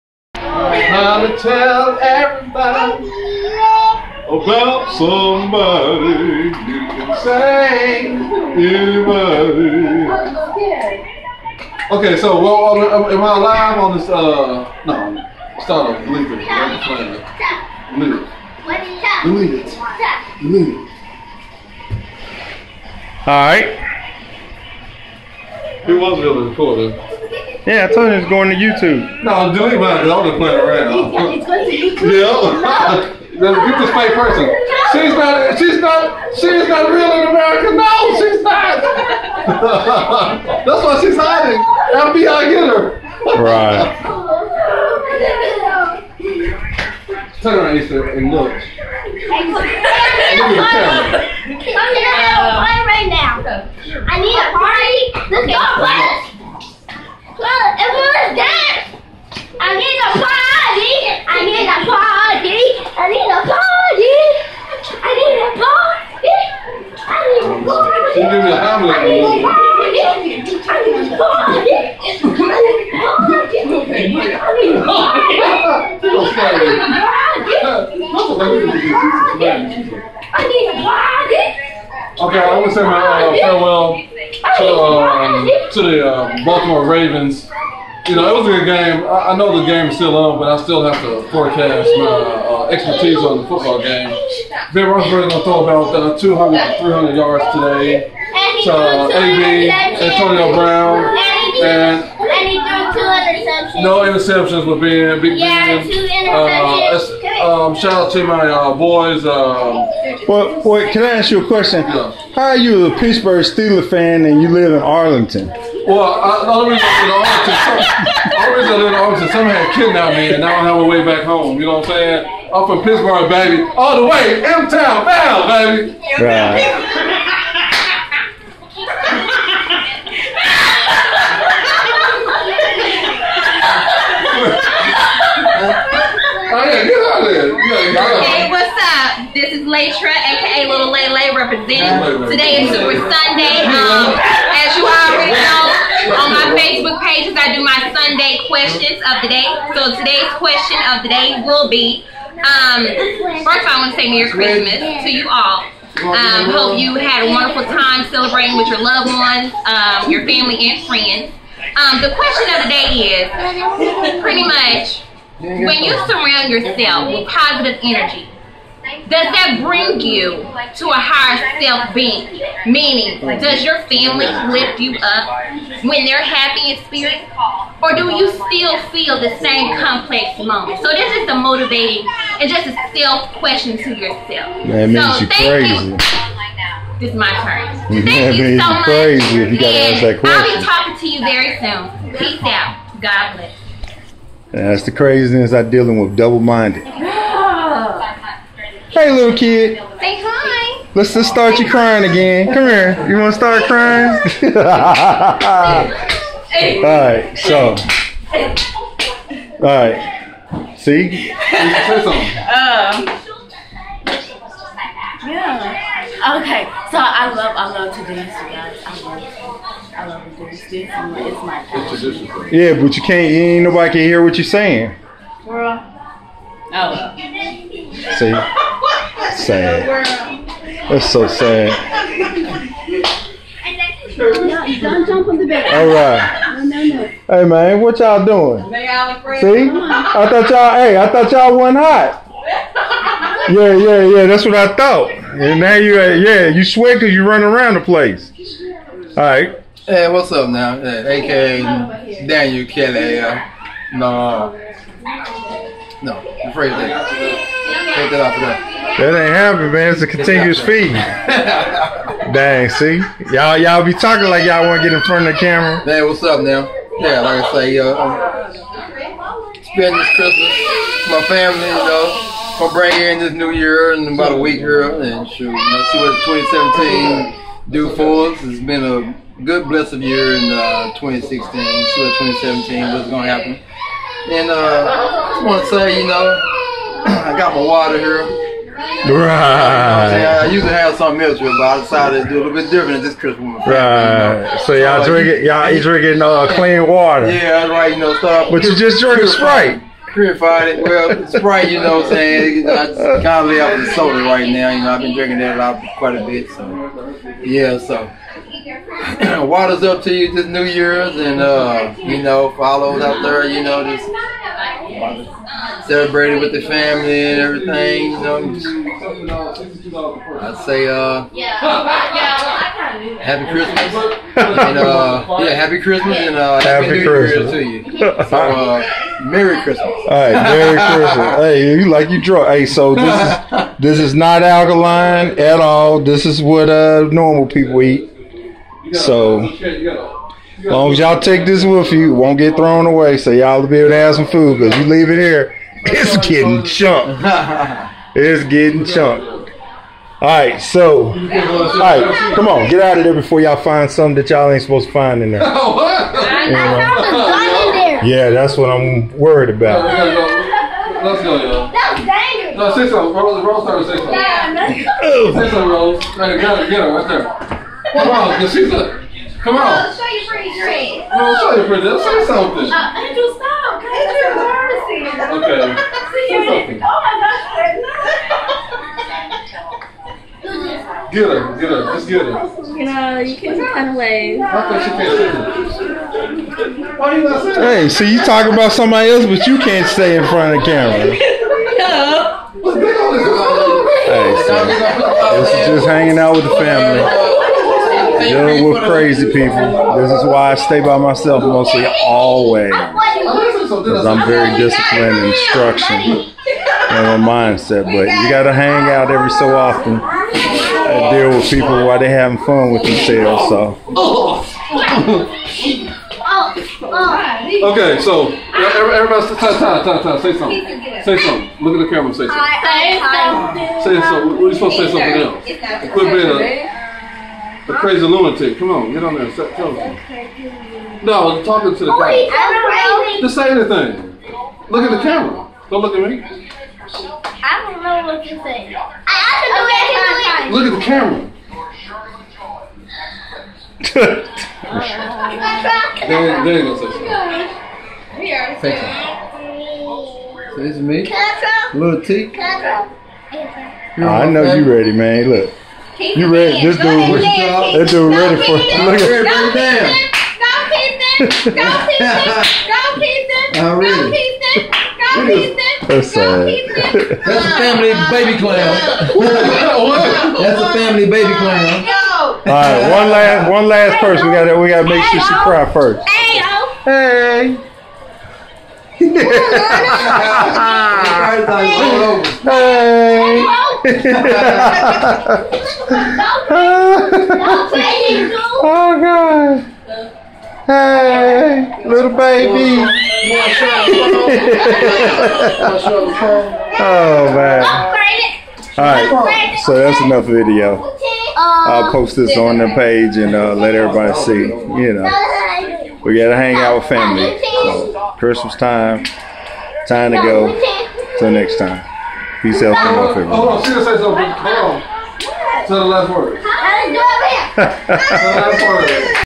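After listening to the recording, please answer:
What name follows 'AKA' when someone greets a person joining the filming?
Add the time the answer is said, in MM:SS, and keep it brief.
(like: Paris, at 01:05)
Daniel Kelly, at 04:12.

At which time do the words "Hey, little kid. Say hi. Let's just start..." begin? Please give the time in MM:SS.
03:18.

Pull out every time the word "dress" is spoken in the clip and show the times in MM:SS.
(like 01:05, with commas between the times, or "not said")
06:10.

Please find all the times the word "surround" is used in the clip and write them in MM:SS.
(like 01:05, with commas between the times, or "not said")
02:46.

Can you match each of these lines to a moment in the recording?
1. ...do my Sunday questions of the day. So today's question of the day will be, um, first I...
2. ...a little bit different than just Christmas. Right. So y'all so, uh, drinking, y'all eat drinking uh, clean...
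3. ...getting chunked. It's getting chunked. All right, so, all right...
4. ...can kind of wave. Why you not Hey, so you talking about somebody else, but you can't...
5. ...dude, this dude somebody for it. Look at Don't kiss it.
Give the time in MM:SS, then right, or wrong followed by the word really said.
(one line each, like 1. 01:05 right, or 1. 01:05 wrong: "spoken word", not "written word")
1. 02:27 right
2. 04:52 right
3. 05:46 right
4. 06:23 right
5. 07:36 wrong: "ready", not "somebody".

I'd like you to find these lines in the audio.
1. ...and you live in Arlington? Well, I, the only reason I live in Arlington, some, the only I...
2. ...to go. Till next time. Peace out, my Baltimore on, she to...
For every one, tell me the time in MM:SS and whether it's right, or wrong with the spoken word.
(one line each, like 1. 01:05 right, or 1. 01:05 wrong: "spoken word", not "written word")
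1. 01:54 right
2. 08:30 wrong: "Hold", not "Baltimore".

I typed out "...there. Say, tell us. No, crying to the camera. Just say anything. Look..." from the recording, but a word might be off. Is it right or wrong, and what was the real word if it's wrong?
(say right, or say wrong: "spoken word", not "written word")
wrong: "talking", not "crying".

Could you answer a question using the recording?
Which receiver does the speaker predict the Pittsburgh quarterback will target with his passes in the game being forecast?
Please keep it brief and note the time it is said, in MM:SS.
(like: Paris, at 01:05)
Antonio Brown, at 01:40.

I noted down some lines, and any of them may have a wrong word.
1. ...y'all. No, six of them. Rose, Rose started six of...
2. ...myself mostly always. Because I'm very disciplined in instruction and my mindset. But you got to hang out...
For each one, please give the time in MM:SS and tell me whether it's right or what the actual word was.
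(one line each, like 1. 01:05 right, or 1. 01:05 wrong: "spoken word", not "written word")
1. 06:01 right
2. 06:40 right.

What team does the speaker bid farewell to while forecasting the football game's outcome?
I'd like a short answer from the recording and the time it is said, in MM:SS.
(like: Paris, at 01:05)
Baltimore Ravens, at 01:26.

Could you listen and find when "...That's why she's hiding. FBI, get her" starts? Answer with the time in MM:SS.
00:40.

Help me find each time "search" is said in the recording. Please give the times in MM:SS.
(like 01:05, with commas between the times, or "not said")
not said.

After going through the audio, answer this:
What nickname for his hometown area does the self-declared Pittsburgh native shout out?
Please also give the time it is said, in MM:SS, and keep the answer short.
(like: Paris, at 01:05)
M-Town, at 02:04.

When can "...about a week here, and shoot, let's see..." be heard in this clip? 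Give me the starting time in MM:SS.
04:34.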